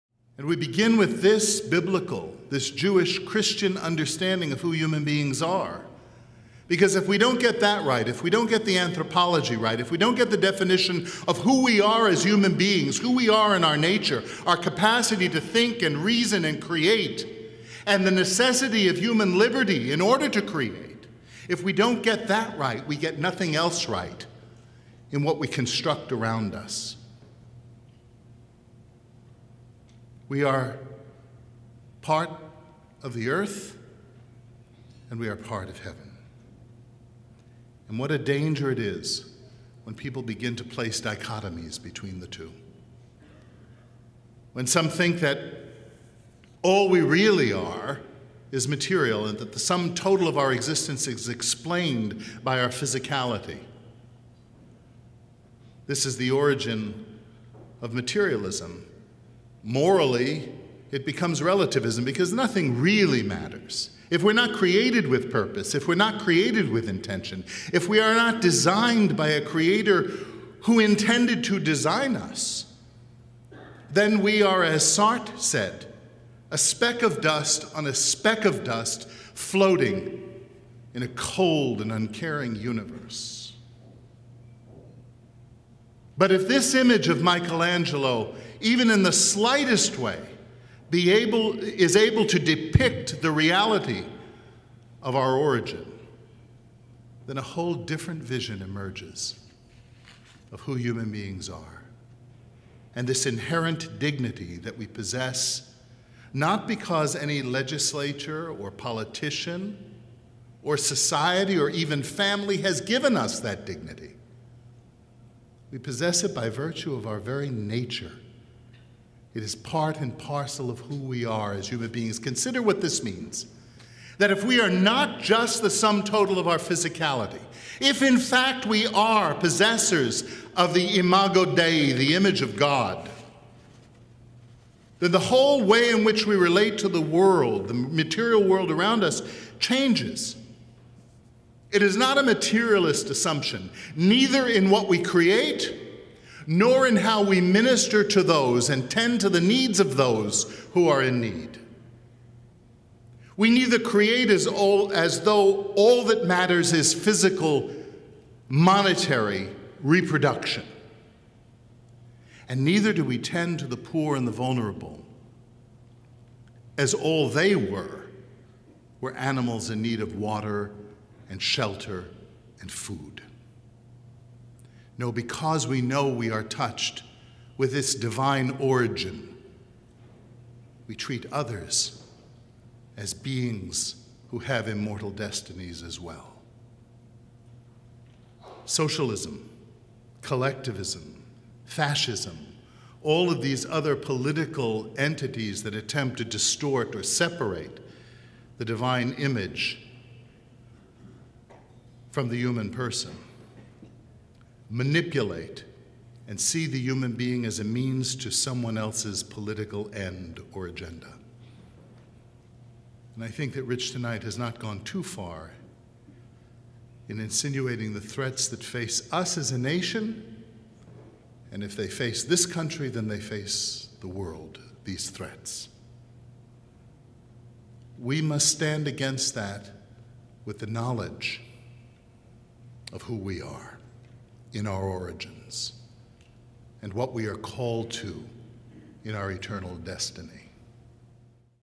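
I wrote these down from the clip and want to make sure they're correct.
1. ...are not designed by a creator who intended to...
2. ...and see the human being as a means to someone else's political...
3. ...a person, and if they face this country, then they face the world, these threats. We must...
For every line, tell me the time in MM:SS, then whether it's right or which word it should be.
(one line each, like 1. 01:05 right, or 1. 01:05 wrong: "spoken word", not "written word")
1. 01:08 right
2. 03:26 right
3. 03:39 wrong: "nation", not "person".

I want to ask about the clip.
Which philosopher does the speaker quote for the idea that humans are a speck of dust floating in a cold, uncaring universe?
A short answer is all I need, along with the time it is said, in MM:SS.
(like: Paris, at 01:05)
Sartre, at 01:14.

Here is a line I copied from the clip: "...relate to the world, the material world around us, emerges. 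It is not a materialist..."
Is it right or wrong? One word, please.
wrong.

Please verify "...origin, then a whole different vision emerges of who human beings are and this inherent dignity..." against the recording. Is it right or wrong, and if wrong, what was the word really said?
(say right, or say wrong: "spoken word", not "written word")
right.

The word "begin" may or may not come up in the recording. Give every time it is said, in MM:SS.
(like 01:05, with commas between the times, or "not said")
00:00, 00:40.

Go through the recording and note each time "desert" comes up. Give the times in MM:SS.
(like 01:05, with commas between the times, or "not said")
not said.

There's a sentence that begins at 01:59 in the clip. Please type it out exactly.
It is part and parcel of who we are as human beings.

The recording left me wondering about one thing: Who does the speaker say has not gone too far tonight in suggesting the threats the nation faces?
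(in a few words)
Rich.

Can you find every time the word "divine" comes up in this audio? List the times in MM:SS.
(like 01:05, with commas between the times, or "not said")
02:57, 03:18.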